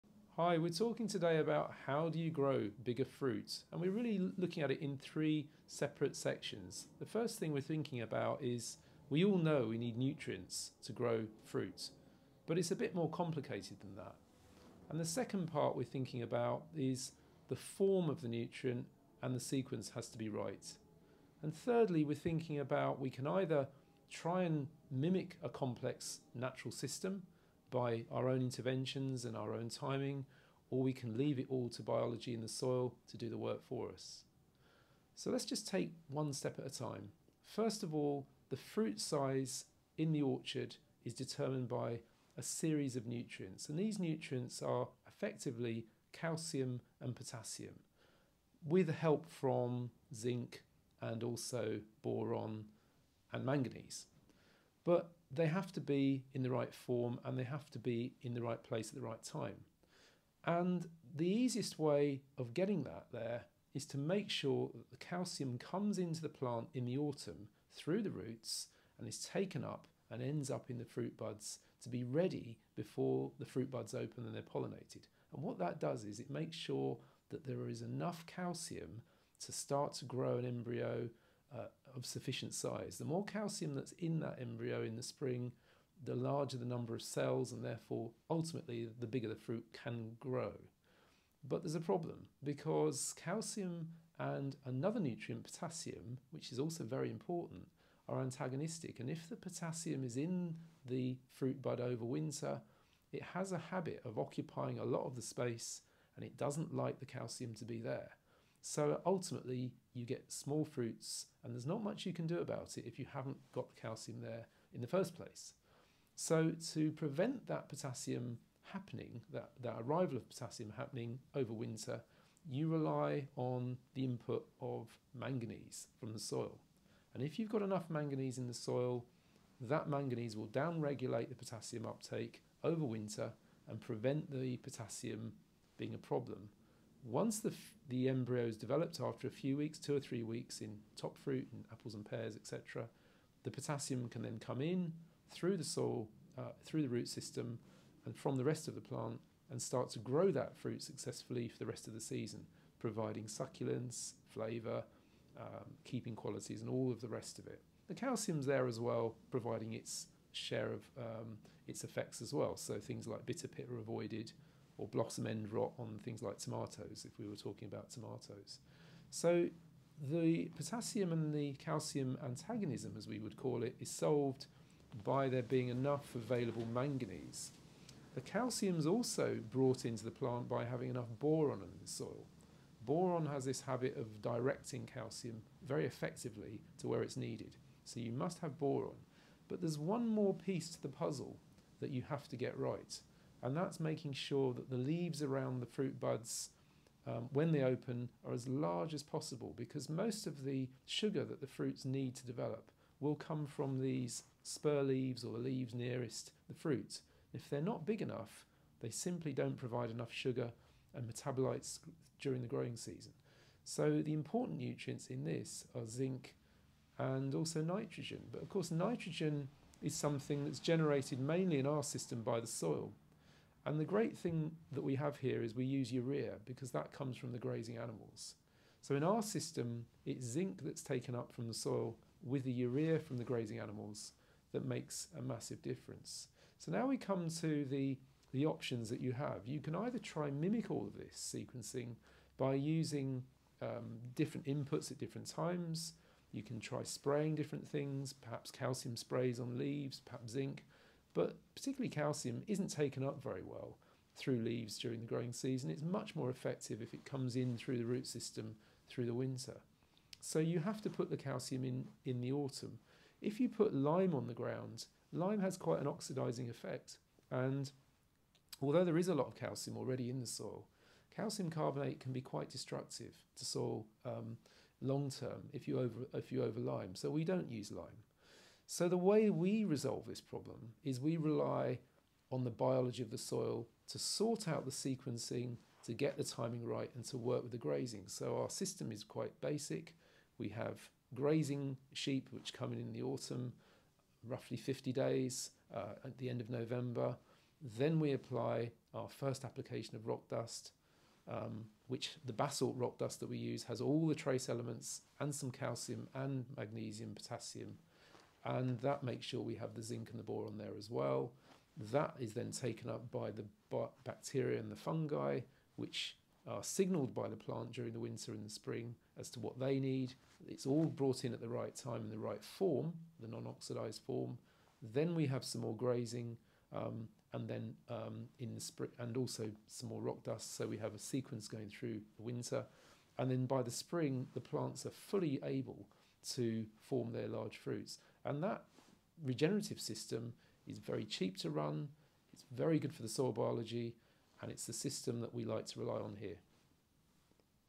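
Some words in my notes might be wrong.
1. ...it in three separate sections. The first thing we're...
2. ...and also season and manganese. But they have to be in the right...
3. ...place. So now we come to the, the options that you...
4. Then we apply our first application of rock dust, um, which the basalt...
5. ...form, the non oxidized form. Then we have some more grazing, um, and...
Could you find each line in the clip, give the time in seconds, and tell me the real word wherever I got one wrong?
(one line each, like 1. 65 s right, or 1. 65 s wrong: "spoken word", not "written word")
1. 4 s right
2. 51 s wrong: "boron", not "season"
3. 235 s wrong: "difference", not "place"
4. 297 s right
5. 322 s right.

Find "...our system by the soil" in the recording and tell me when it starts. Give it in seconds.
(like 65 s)
221 s.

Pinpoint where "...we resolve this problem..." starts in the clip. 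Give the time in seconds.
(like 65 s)
279 s.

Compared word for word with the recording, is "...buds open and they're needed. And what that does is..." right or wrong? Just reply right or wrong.
wrong.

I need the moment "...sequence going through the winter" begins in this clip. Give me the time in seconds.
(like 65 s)
330 s.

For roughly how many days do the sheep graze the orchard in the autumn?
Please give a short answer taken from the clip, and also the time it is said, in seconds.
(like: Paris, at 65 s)
50 days, at 294 s.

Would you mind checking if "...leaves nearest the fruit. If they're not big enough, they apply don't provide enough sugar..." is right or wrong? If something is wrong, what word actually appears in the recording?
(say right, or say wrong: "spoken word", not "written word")
wrong: "simply", not "apply".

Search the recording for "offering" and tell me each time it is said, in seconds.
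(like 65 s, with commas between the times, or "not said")
not said.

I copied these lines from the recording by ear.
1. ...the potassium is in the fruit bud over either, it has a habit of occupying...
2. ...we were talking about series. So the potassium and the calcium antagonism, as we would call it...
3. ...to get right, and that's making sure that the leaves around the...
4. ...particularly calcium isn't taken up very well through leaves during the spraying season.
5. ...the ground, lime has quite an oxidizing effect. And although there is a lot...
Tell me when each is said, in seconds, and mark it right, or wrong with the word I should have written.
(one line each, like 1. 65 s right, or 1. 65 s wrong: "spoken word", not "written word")
1. 99 s wrong: "winter", not "either"
2. 167 s wrong: "tomatoes", not "series"
3. 192 s right
4. 251 s wrong: "growing", not "spraying"
5. 264 s right.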